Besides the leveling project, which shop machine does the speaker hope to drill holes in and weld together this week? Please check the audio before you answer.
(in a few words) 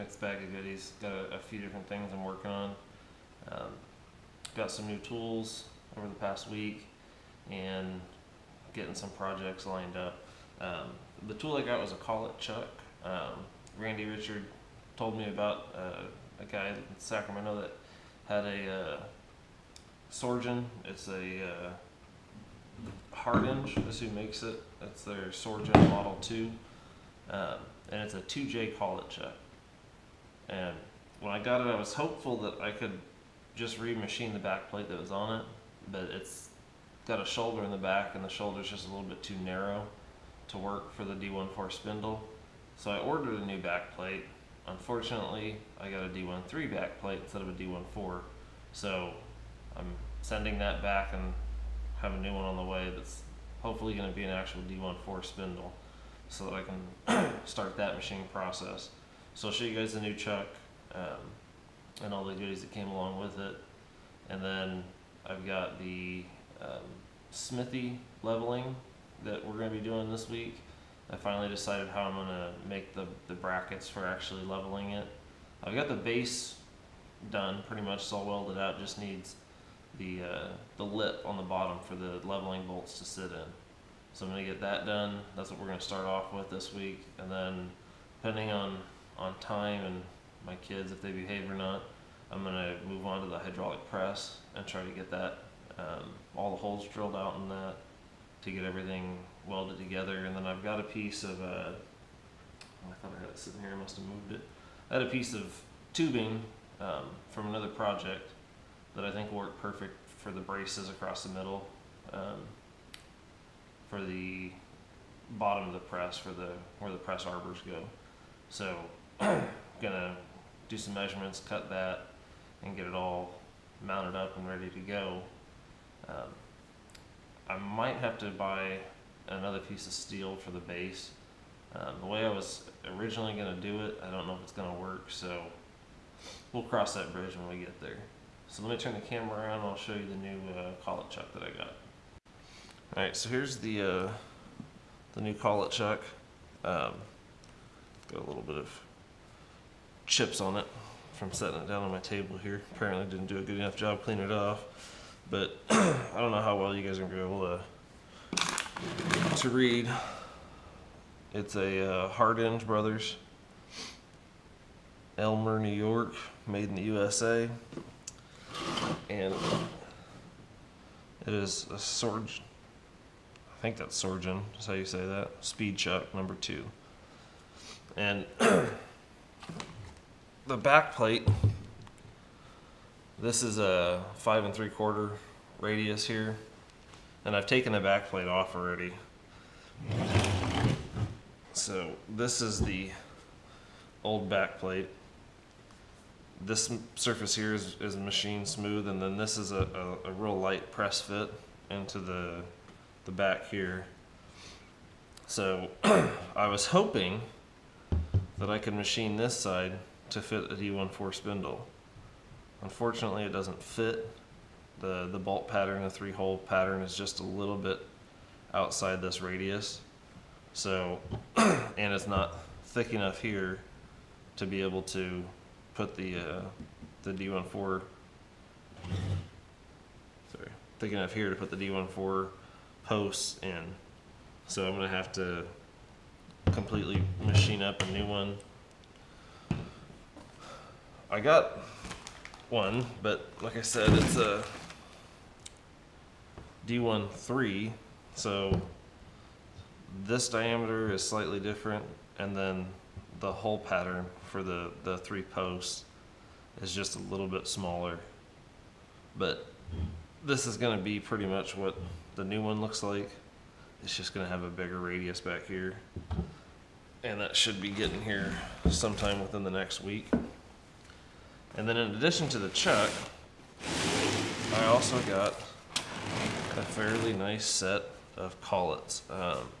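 hydraulic press.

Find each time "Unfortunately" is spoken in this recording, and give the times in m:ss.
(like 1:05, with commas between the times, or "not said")
0:44, 3:32.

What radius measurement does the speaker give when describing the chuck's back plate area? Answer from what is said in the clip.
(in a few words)
5 3/4.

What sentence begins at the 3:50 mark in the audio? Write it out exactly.
Sorry, thick enough here to put the D14 posts in.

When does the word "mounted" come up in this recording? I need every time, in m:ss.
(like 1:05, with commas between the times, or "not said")
2:03.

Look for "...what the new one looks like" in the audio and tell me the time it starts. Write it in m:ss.
4:21.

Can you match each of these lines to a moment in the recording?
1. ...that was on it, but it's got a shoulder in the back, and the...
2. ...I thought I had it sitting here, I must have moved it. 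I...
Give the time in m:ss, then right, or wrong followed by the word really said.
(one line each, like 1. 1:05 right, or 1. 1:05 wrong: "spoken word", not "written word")
1. 0:34 right
2. 1:42 right.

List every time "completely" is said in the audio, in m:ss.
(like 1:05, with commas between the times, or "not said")
3:56.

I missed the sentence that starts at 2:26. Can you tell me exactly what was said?
Um, got a little bit of chips on it from setting it down on my table here.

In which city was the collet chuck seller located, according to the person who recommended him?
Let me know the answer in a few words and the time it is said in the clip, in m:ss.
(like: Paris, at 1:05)
Sacramento, at 0:16.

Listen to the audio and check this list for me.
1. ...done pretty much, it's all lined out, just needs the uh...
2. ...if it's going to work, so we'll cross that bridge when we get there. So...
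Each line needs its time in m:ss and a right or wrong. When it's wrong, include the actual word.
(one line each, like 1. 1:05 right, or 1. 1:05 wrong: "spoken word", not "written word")
1. 1:17 wrong: "welded", not "lined"
2. 2:14 right.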